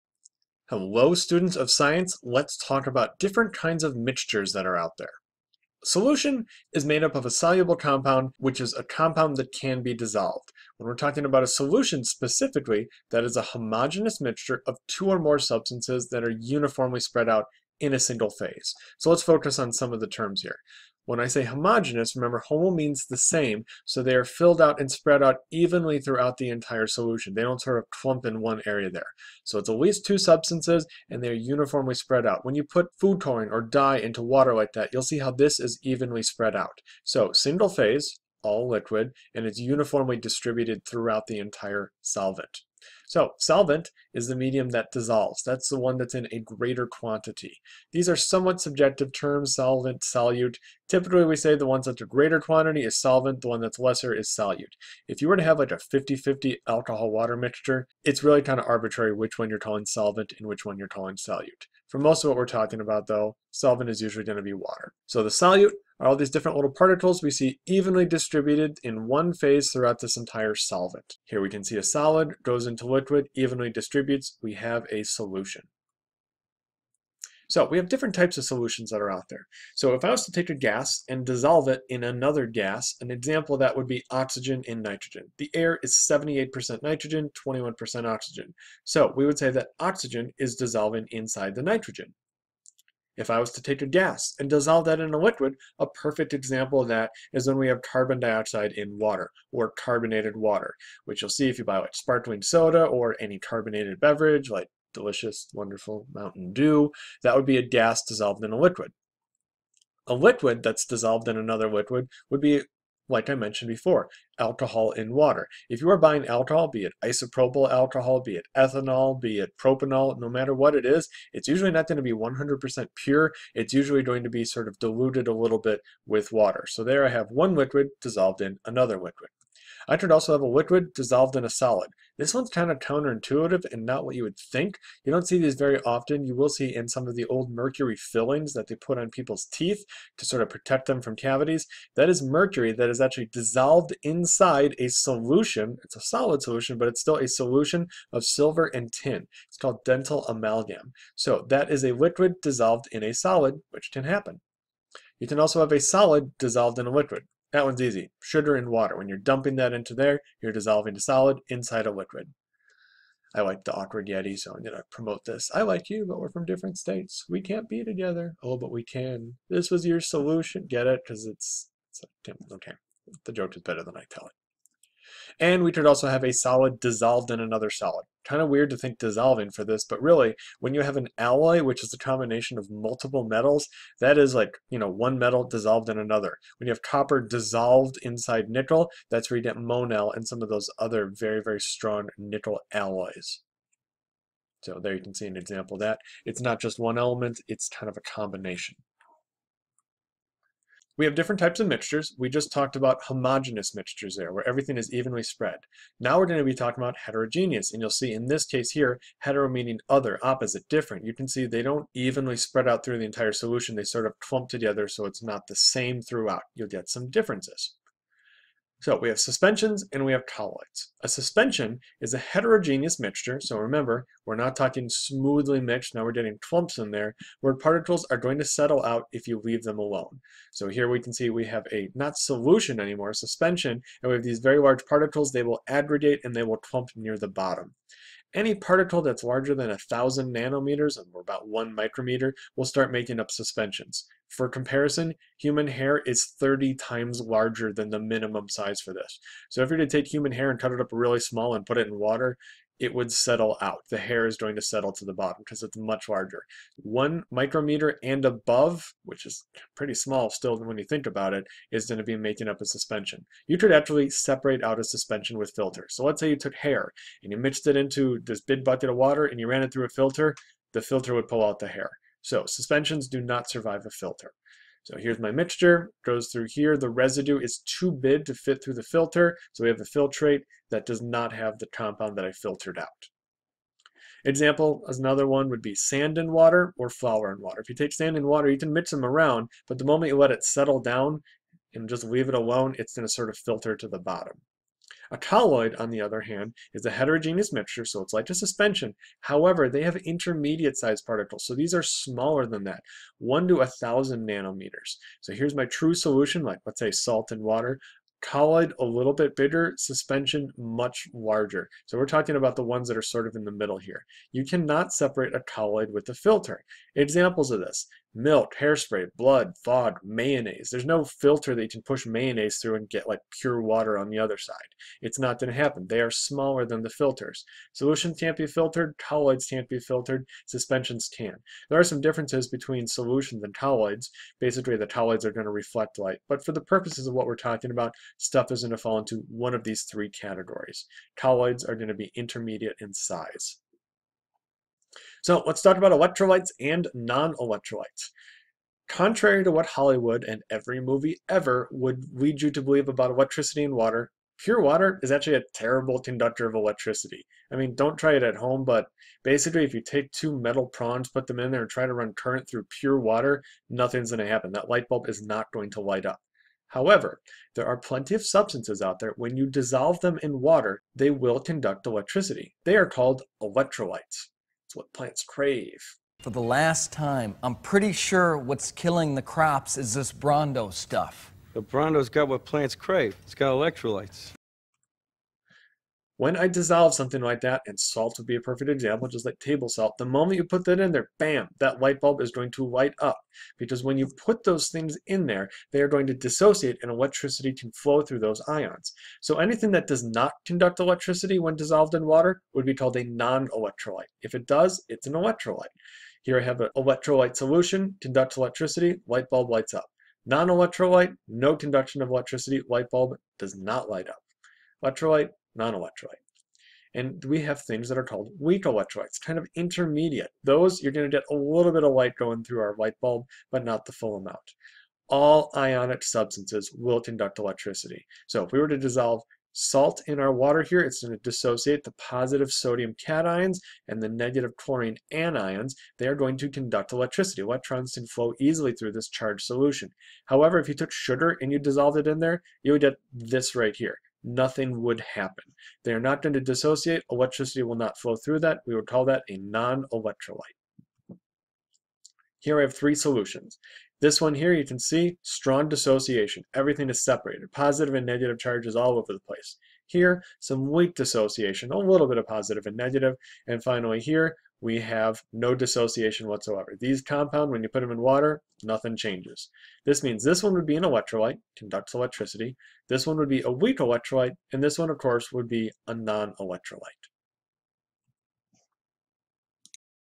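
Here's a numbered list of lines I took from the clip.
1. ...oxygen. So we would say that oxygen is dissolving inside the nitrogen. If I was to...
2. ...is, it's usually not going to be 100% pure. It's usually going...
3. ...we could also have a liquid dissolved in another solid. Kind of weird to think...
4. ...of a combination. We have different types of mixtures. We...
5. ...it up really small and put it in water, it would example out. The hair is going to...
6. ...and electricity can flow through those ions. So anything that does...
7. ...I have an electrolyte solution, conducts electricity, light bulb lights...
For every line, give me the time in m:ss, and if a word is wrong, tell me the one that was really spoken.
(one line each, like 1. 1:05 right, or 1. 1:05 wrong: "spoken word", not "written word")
1. 1:28 right
2. 2:00 right
3. 2:55 wrong: "solid", not "liquid"
4. 3:17 right
5. 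4:10 wrong: "settle", not "example"
6. 6:36 right
7. 6:46 right.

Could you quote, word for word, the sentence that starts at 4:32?
So suspensions do not survive a filter.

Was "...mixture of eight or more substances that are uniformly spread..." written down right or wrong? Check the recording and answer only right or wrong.
wrong.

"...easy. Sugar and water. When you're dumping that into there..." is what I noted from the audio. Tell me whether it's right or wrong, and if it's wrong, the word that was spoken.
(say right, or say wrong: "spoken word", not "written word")
right.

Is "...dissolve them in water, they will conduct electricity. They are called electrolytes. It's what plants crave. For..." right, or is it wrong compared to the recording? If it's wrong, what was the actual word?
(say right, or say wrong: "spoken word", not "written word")
right.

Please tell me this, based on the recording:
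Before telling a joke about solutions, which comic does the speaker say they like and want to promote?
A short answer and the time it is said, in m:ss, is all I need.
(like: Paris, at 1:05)
the awkward Yeti, at 2:43.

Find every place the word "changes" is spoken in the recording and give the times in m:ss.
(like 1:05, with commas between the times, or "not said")
7:48.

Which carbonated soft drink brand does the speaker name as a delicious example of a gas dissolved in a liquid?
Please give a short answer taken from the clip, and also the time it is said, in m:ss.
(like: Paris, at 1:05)
Mountain Dew, at 1:46.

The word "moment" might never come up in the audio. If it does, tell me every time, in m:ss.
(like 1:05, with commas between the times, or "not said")
4:49, 6:30.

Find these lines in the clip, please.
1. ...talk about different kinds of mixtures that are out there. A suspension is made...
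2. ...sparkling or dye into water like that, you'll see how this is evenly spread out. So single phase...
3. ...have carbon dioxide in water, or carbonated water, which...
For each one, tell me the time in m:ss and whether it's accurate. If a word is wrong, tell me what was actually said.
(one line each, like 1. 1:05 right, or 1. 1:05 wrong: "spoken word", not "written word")
1. 0:02 wrong: "solution", not "suspension"
2. 0:33 wrong: "coloring", not "sparkling"
3. 1:37 right.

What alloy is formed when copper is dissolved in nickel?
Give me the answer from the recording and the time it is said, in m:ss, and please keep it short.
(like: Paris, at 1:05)
monel, at 3:09.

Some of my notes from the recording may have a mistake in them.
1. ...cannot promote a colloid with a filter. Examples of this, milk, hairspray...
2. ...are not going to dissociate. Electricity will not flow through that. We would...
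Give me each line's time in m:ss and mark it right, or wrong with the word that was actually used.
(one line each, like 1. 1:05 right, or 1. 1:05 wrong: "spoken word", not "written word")
1. 5:14 wrong: "separate", not "promote"
2. 7:25 right.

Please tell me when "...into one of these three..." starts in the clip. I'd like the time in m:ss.
5:38.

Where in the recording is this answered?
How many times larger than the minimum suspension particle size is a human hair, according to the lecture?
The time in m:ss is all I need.
4:06.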